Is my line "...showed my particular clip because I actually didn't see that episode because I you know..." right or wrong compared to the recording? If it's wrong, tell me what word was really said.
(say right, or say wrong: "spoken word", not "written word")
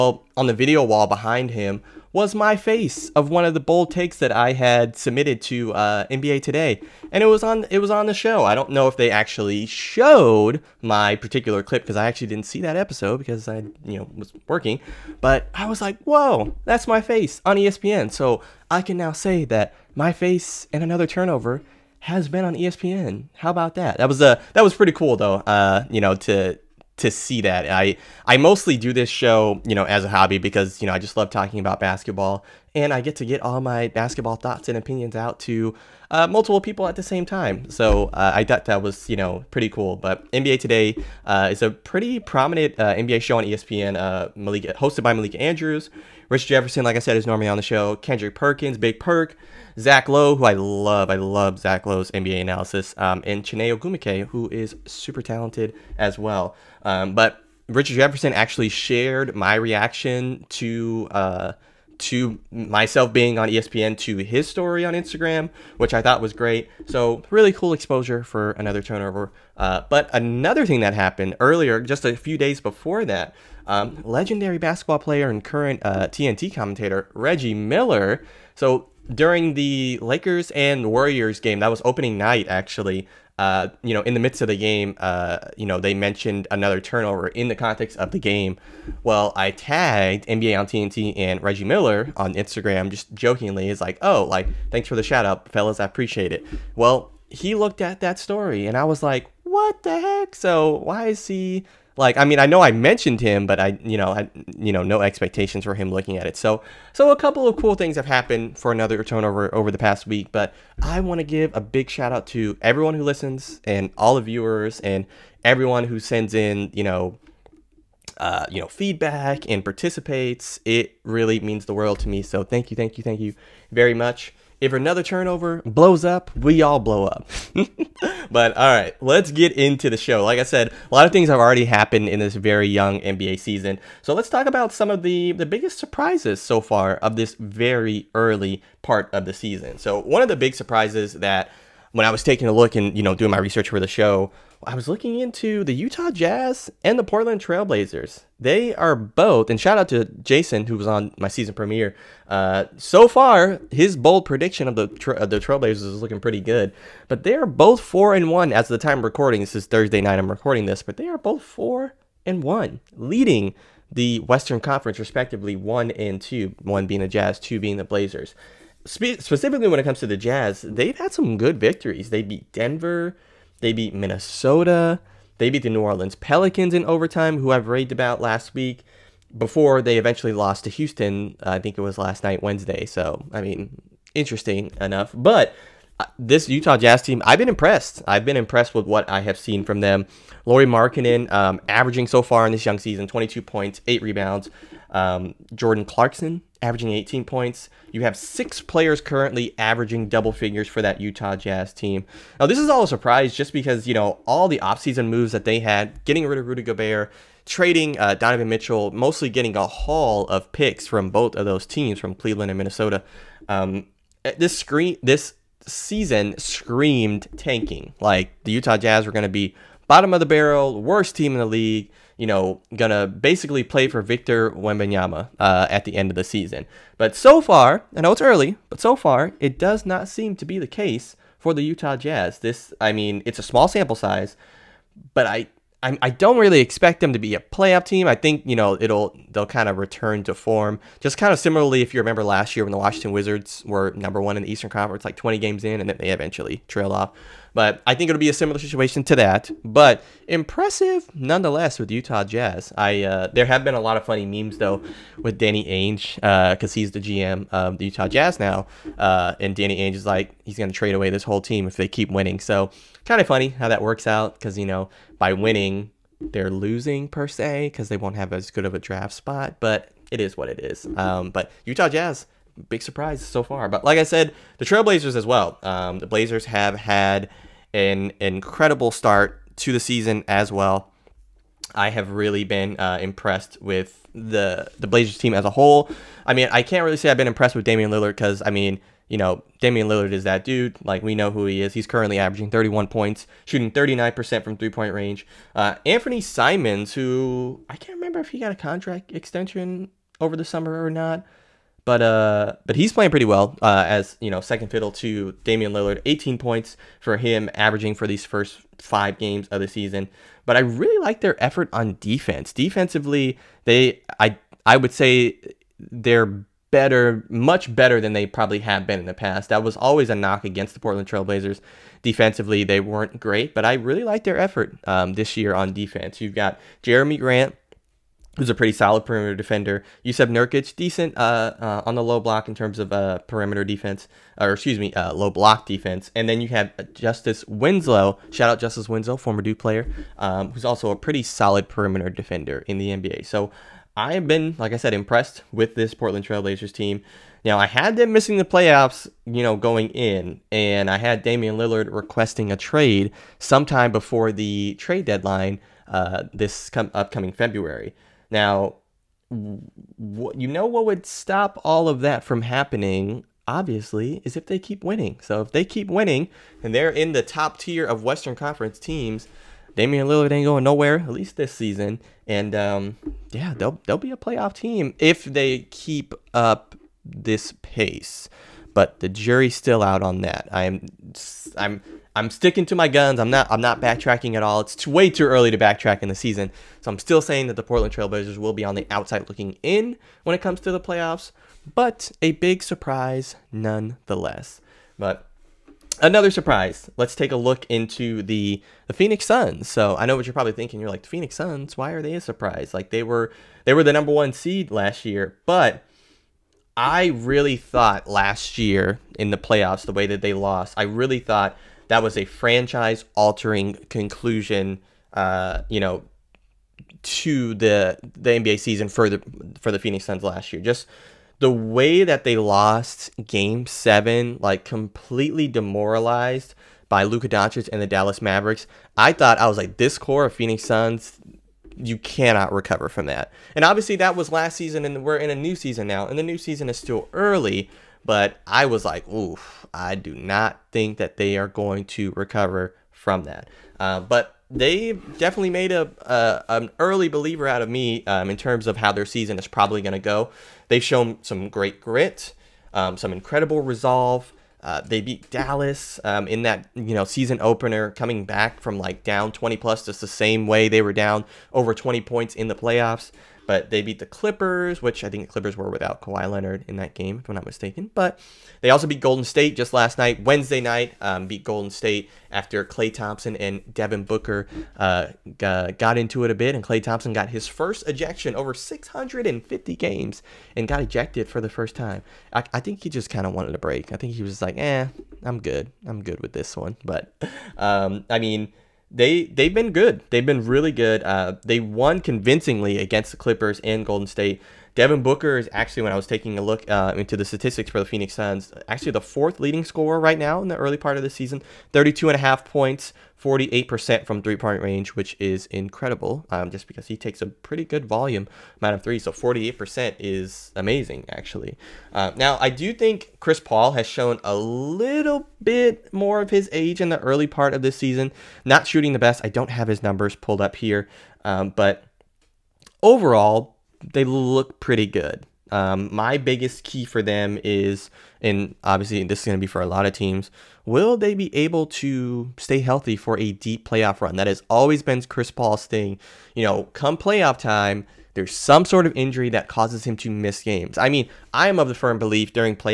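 right.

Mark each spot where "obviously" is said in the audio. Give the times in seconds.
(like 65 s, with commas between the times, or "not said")
363 s, 433 s, 528 s.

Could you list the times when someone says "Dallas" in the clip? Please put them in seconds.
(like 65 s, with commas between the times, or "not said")
427 s, 455 s.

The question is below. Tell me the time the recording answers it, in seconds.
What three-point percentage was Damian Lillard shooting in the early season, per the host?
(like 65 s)
293 s.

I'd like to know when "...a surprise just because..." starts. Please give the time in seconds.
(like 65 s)
202 s.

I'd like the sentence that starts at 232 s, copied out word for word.
This, I mean, it's a small sample size, but I I, I don't really expect them to be a playoff team.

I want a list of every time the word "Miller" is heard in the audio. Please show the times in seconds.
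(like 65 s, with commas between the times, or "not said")
77 s, 91 s.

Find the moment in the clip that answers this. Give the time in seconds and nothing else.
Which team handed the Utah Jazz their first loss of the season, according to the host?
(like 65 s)
180 s.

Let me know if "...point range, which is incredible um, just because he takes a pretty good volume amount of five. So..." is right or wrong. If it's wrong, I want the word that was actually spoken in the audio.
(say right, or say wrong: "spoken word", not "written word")
wrong: "three", not "five".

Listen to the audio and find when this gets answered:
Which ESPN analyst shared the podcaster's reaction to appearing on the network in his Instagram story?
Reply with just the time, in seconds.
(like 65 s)
57 s.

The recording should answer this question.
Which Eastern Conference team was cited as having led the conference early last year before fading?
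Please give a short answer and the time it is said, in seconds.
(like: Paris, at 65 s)
Washington Wizards, at 242 s.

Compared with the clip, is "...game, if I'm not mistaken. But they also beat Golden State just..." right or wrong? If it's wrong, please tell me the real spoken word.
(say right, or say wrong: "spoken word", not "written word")
right.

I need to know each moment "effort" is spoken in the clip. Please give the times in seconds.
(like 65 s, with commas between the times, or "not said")
311 s, 324 s.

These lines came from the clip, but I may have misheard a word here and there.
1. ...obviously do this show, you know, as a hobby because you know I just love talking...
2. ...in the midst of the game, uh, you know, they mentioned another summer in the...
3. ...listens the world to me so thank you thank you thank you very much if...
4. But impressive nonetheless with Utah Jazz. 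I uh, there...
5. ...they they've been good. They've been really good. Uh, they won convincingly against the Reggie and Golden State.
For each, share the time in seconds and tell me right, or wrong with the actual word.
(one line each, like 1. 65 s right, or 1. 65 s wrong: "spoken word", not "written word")
1. 28 s wrong: "mostly", not "obviously"
2. 84 s wrong: "turnover", not "summer"
3. 121 s wrong: "means", not "listens"
4. 249 s right
5. 488 s wrong: "Clippers", not "Reggie".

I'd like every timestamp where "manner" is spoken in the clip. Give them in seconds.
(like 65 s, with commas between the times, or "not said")
not said.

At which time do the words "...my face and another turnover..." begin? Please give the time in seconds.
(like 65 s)
19 s.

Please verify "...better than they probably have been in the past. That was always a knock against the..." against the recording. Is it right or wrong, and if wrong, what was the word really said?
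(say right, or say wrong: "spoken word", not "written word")
right.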